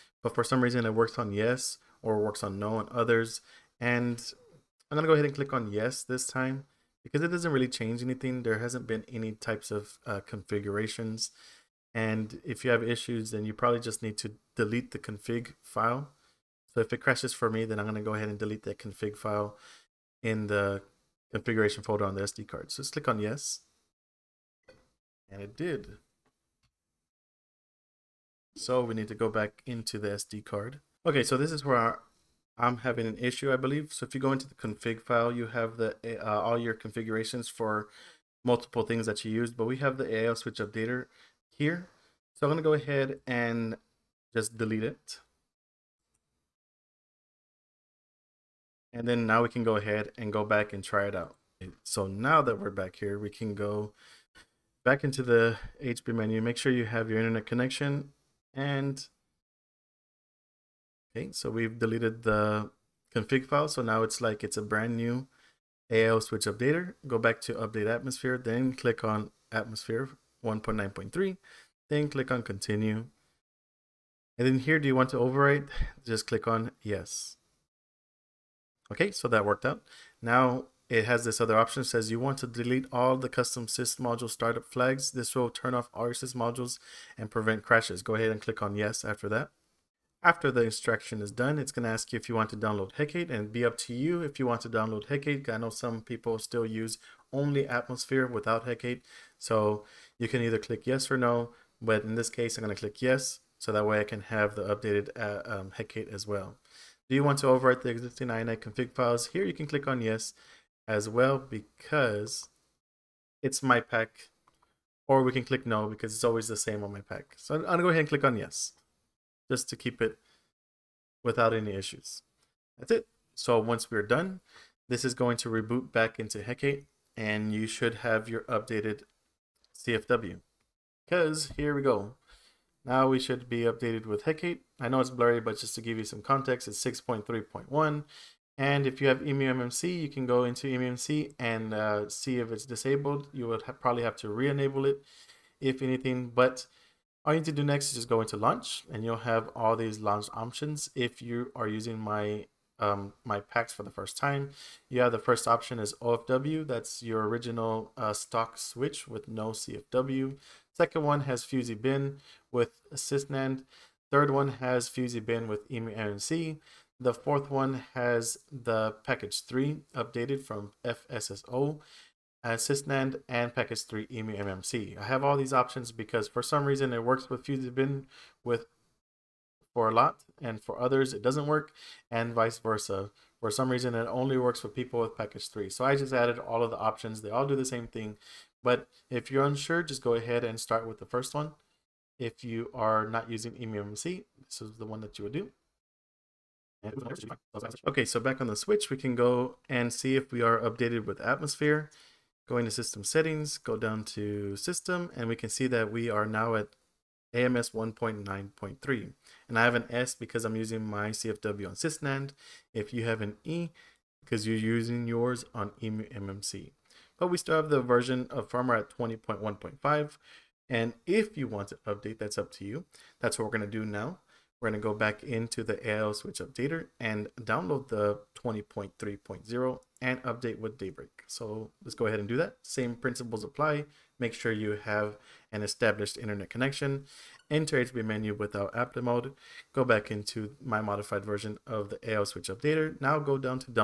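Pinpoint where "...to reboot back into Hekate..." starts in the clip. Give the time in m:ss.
2:05.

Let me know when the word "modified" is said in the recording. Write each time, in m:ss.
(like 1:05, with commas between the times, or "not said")
4:00.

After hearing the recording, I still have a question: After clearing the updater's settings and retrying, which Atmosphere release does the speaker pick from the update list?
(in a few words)
1.9.3.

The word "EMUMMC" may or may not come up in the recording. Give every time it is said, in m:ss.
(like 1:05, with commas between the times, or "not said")
2:19, 2:45.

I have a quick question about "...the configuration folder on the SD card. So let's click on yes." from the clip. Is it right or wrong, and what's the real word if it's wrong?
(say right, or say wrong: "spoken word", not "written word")
right.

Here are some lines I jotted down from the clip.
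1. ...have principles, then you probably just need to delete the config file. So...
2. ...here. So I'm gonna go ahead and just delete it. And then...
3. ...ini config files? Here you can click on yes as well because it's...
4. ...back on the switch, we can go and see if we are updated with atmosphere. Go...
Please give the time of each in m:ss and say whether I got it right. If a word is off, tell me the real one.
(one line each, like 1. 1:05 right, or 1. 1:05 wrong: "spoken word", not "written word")
1. 0:12 wrong: "issues", not "principles"
2. 0:41 right
3. 1:48 right
4. 3:18 right.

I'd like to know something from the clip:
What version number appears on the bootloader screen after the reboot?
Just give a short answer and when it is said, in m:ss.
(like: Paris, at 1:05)
6.3.1, at 2:16.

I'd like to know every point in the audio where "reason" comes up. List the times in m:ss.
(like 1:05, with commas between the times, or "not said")
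0:00, 2:56, 3:03.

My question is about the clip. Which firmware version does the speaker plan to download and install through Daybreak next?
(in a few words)
20.3.0.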